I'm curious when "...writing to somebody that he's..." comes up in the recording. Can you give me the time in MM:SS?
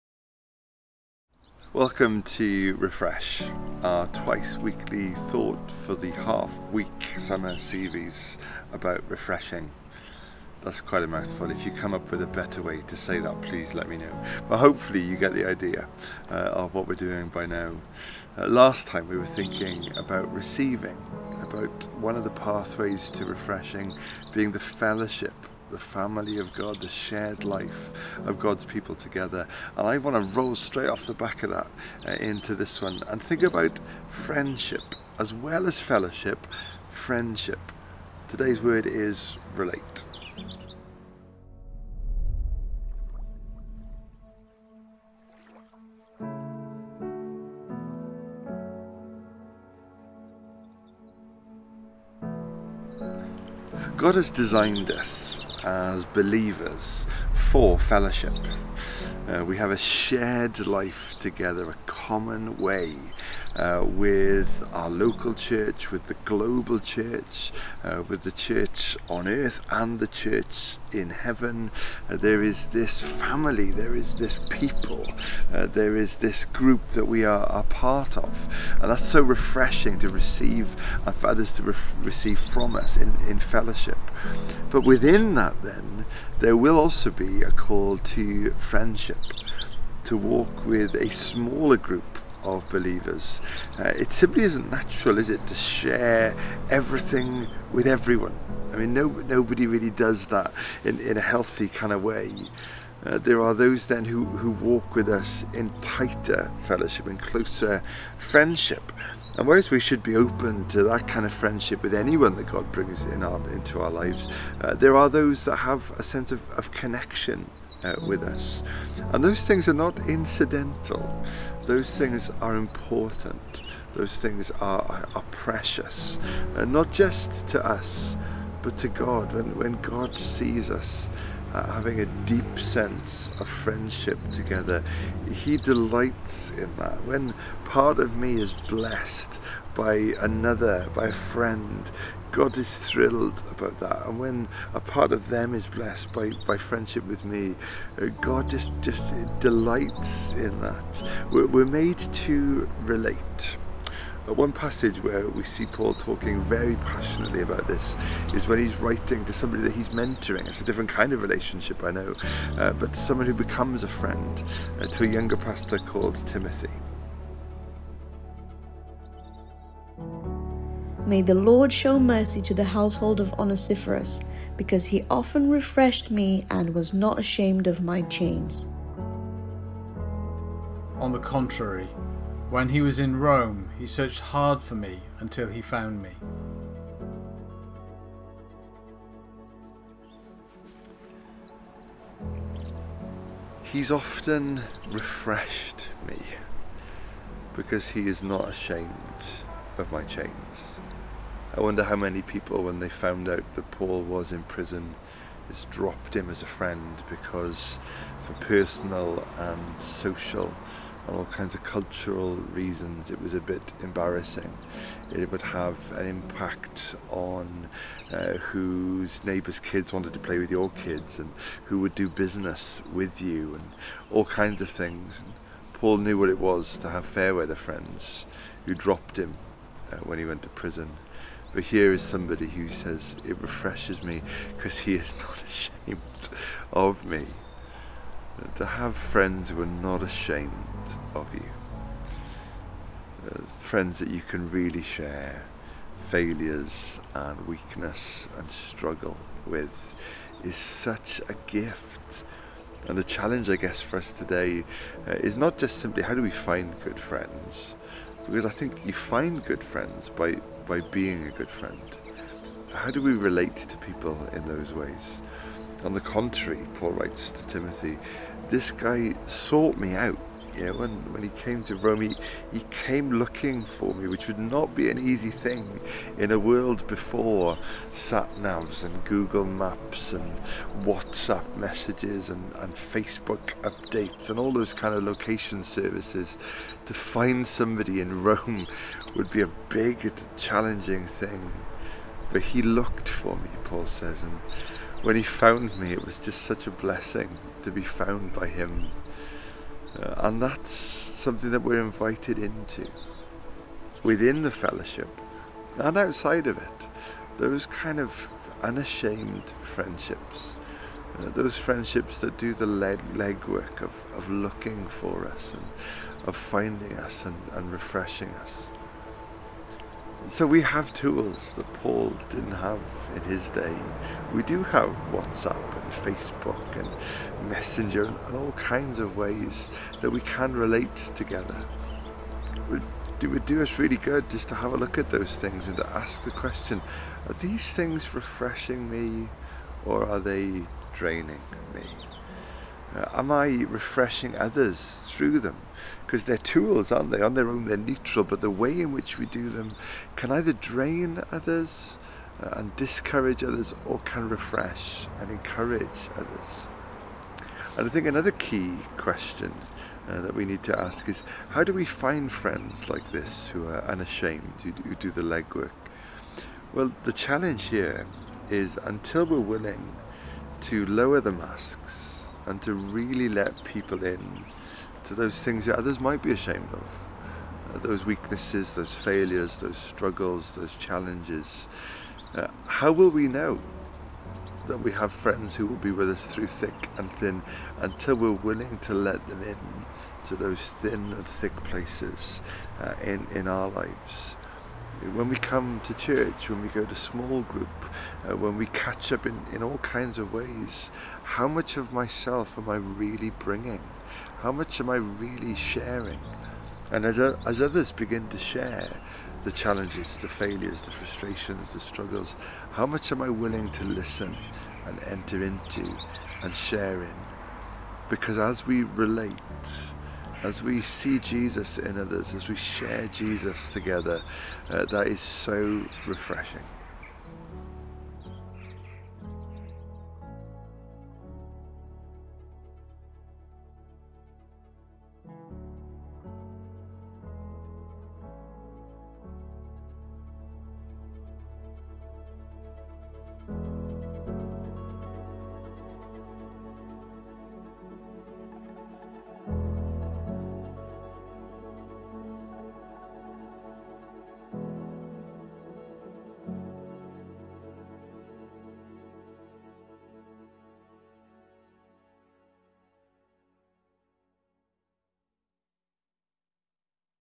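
02:38.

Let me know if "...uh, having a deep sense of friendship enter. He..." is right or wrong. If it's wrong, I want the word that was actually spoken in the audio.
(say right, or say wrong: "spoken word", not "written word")
wrong: "together", not "enter".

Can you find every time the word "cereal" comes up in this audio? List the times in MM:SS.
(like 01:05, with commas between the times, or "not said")
not said.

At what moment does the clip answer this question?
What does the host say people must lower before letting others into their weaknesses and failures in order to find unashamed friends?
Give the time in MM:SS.
06:11.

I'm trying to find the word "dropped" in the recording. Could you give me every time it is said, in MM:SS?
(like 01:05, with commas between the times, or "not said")
03:25, 03:48.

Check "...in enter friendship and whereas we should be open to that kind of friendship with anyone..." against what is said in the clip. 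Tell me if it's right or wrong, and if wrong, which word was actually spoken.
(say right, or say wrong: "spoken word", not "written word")
wrong: "closer", not "enter".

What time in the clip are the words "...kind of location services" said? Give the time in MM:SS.
04:44.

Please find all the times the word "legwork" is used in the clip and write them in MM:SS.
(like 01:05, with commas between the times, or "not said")
05:13, 06:05.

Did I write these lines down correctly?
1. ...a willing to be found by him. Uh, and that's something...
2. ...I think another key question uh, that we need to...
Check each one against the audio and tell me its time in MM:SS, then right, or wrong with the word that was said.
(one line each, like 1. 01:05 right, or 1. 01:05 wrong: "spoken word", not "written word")
1. 04:56 wrong: "blessing", not "willing"
2. 05:57 right.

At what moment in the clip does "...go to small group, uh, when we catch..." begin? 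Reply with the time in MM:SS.
06:36.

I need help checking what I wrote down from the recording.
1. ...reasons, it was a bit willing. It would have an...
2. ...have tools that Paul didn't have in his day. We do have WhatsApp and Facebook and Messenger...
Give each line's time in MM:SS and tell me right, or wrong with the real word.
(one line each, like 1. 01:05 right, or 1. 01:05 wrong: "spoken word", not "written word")
1. 03:32 wrong: "embarrassing", not "willing"
2. 05:20 right.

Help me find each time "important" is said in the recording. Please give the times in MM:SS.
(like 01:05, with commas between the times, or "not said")
02:02.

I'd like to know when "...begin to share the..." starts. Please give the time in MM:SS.
06:47.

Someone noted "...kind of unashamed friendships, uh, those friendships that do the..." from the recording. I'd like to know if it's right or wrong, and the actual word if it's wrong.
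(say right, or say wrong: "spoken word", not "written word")
right.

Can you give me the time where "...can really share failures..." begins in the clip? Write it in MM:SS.
04:04.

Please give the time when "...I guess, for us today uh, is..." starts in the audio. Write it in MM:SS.
04:13.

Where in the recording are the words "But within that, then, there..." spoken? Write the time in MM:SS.
01:24.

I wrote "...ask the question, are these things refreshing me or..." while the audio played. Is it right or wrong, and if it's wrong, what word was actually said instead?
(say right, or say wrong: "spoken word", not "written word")
right.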